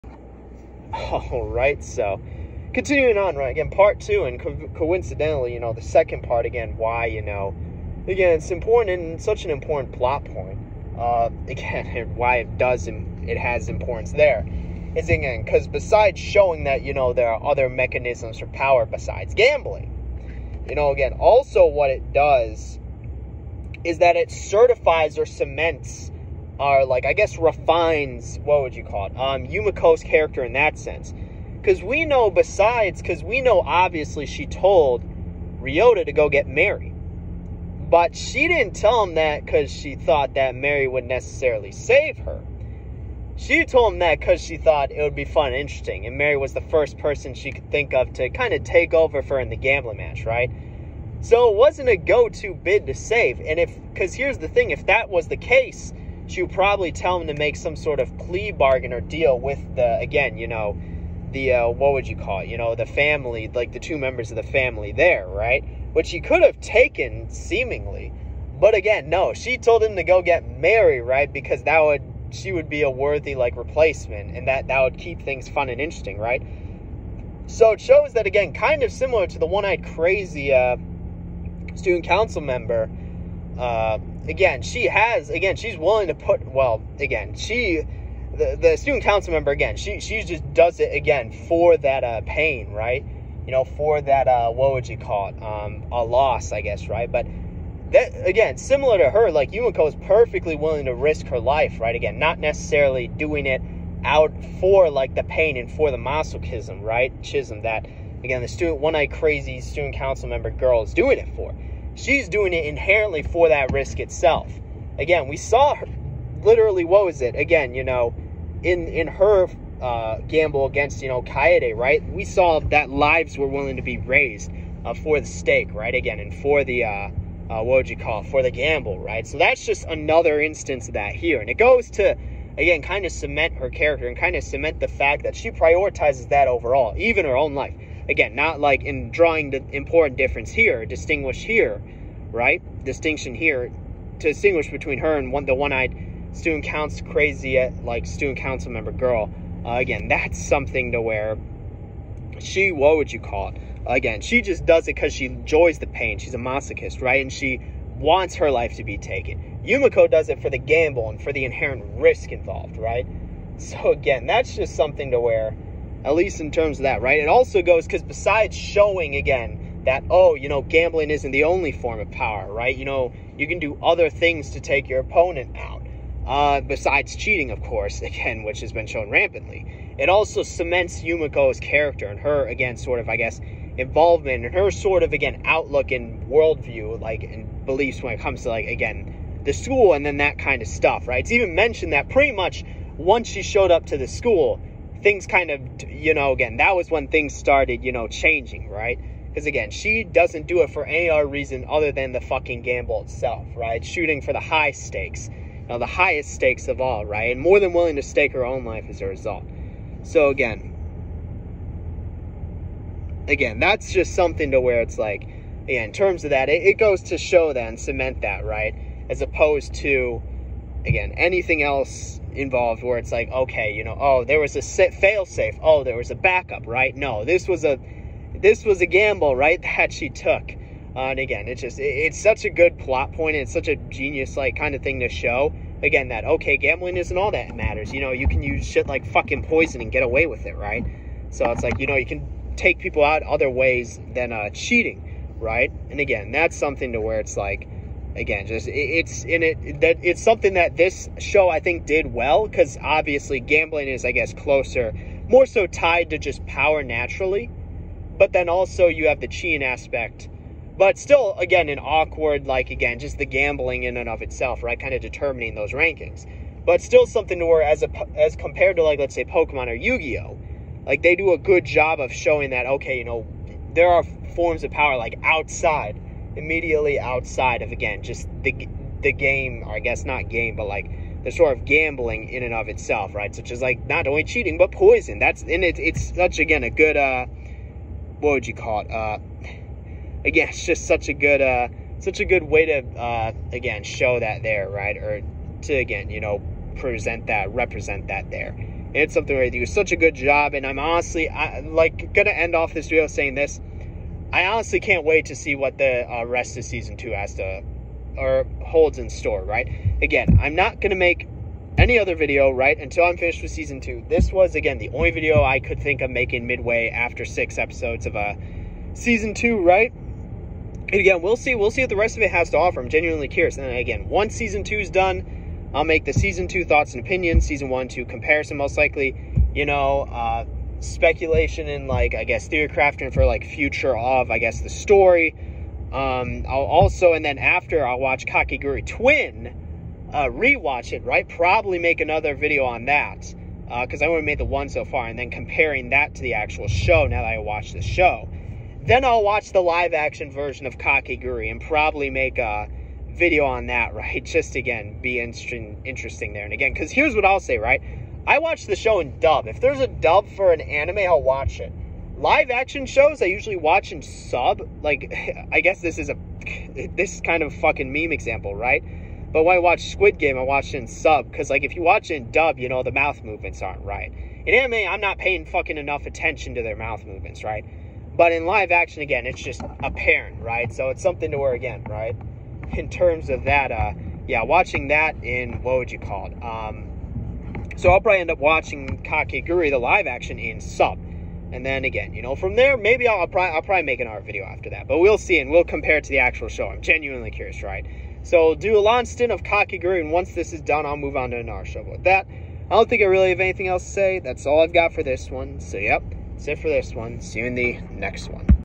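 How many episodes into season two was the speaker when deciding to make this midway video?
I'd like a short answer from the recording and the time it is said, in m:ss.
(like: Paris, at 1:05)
6, at 5:17.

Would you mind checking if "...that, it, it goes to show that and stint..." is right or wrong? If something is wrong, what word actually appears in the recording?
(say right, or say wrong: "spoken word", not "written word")
wrong: "cement", not "stint".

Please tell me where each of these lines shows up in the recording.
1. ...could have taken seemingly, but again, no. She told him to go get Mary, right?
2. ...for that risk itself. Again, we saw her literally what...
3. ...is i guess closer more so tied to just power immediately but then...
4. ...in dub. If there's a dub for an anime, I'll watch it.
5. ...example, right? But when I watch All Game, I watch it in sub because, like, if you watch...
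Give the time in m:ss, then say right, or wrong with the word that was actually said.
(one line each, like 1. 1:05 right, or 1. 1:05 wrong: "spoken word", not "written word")
1. 1:06 right
2. 1:53 right
3. 4:13 wrong: "naturally", not "immediately"
4. 5:58 right
5. 6:08 wrong: "Squid", not "All".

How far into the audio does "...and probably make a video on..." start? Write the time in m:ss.
5:51.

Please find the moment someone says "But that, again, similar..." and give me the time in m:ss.
1:37.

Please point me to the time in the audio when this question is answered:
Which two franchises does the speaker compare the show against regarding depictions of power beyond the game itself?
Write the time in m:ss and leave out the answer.
4:29.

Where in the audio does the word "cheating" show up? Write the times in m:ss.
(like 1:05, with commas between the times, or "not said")
2:57, 4:04, 4:19, 4:44.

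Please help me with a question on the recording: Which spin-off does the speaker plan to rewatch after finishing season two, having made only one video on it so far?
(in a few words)
Kakegurui Twin.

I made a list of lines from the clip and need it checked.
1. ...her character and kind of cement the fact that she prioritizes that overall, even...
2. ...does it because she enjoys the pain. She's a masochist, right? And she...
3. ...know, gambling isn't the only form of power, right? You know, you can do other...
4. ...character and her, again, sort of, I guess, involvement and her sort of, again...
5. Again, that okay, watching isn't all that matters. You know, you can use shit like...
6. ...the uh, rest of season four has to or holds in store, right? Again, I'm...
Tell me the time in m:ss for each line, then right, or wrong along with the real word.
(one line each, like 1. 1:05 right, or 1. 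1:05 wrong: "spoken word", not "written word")
1. 2:13 right
2. 2:34 right
3. 2:50 right
4. 3:01 right
5. 3:55 wrong: "gambling", not "watching"
6. 5:05 wrong: "two", not "four".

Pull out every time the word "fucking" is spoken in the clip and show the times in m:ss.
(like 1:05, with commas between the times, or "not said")
3:22, 3:59, 6:07, 6:15.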